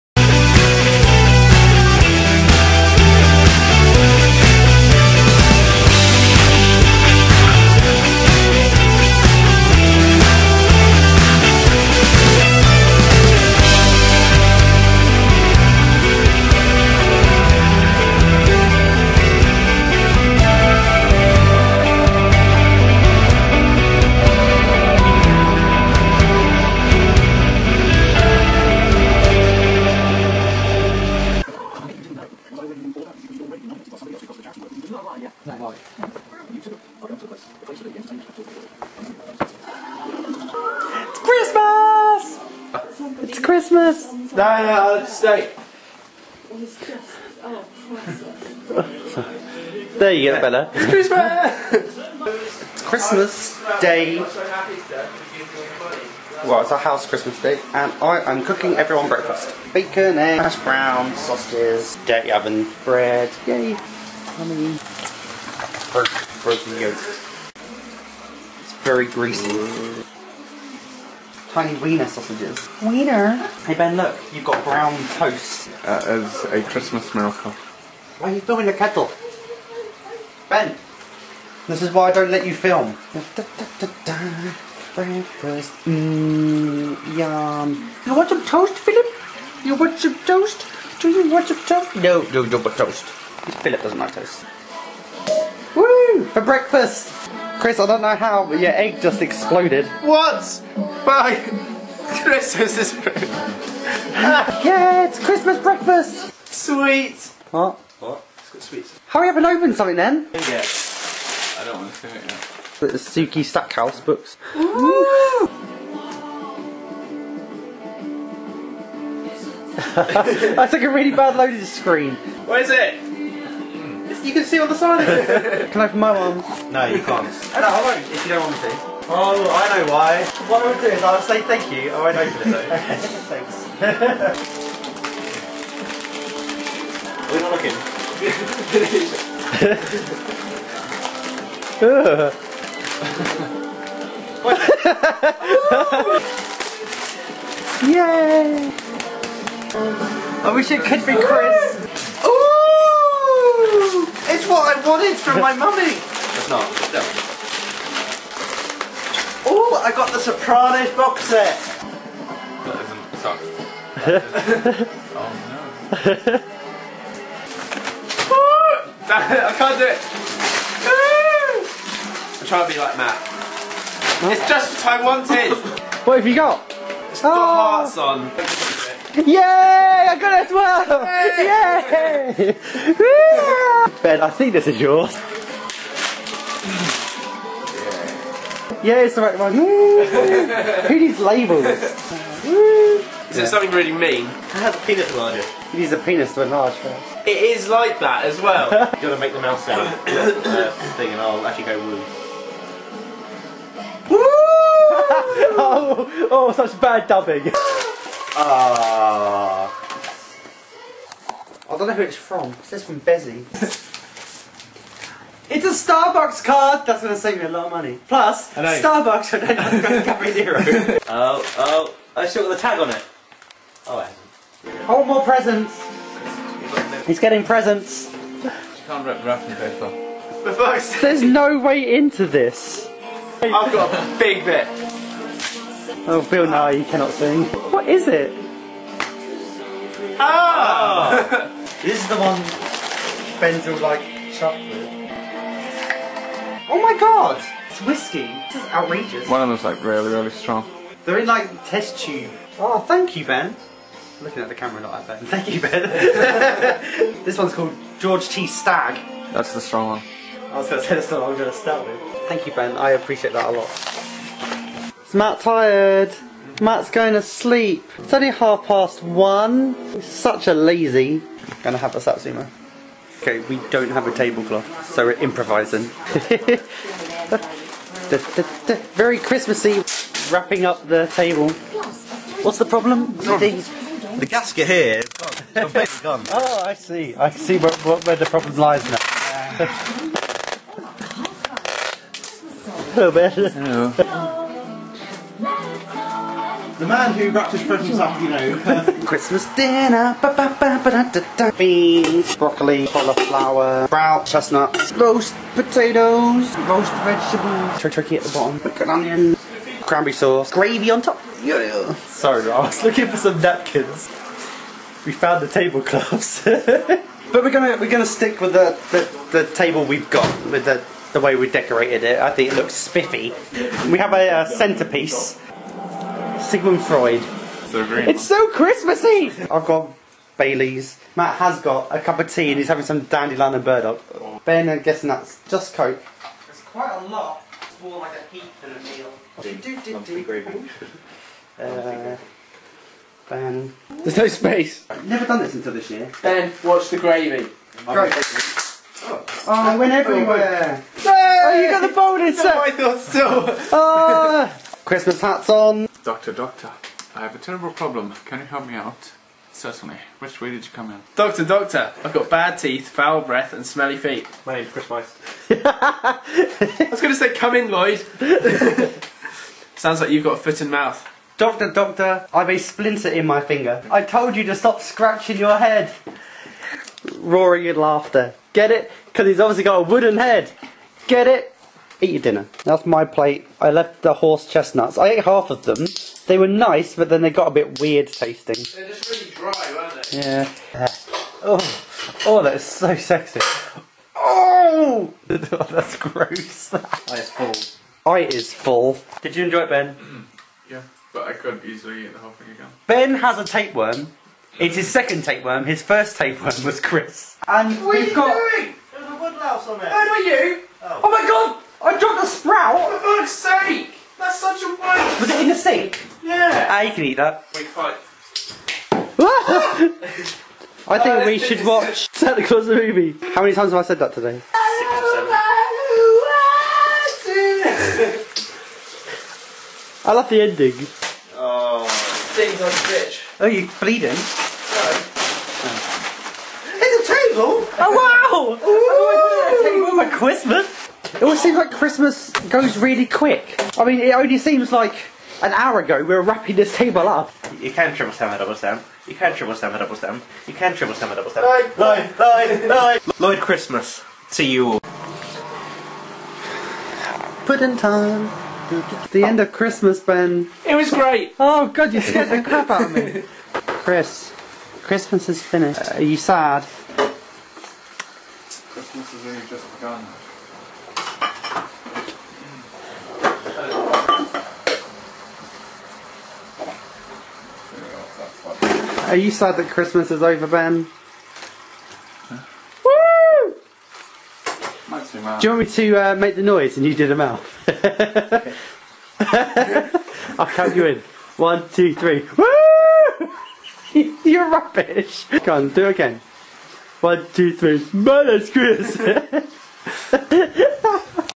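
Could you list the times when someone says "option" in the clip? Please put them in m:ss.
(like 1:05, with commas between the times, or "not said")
not said.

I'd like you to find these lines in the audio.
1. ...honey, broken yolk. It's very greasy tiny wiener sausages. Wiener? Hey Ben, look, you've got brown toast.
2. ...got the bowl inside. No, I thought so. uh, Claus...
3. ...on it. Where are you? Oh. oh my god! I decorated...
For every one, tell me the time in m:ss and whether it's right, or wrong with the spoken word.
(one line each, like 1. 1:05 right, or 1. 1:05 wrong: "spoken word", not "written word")
1. 1:03 right
2. 5:51 wrong: "Christmas", not "Claus"
3. 6:49 wrong: "dropped", not "decorated".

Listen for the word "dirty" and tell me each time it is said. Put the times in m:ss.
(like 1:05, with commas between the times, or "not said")
1:02.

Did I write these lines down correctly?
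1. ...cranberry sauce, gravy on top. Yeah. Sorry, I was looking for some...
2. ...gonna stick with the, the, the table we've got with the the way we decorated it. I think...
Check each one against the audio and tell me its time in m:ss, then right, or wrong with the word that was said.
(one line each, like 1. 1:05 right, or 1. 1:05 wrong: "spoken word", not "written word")
1. 5:09 right
2. 5:17 right.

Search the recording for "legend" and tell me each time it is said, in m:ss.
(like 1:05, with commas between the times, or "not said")
not said.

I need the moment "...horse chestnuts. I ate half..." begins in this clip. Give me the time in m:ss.
6:24.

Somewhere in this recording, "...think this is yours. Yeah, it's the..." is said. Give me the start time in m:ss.
3:04.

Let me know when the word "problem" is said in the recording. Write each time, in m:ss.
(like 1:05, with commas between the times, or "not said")
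4:42, 4:48, 5:57.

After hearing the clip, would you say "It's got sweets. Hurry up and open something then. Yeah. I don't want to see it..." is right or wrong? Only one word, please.
right.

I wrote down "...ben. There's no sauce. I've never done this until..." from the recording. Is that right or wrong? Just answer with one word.
wrong.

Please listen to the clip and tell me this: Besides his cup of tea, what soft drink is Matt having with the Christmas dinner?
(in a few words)
dandelion and burdock.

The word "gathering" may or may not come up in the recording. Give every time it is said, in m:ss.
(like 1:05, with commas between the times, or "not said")
not said.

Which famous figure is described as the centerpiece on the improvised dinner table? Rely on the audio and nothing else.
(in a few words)
Sigmund Freud.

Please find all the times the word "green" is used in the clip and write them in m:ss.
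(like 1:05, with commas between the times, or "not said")
5:27.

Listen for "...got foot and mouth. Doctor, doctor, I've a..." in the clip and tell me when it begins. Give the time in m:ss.
6:10.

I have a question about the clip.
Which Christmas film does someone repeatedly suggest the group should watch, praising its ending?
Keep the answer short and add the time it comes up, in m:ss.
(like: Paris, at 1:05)
Santa Claus the Movie, at 7:02.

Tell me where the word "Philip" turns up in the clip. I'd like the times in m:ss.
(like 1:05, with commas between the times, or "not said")
1:28, 1:33.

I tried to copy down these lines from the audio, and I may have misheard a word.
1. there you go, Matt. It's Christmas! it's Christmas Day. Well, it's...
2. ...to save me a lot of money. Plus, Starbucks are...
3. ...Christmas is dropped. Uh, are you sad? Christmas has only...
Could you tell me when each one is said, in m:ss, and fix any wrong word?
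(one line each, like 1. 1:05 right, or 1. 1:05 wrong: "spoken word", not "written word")
1. 0:49 wrong: "Bella", not "Matt"
2. 3:37 right
3. 7:44 wrong: "finished", not "dropped".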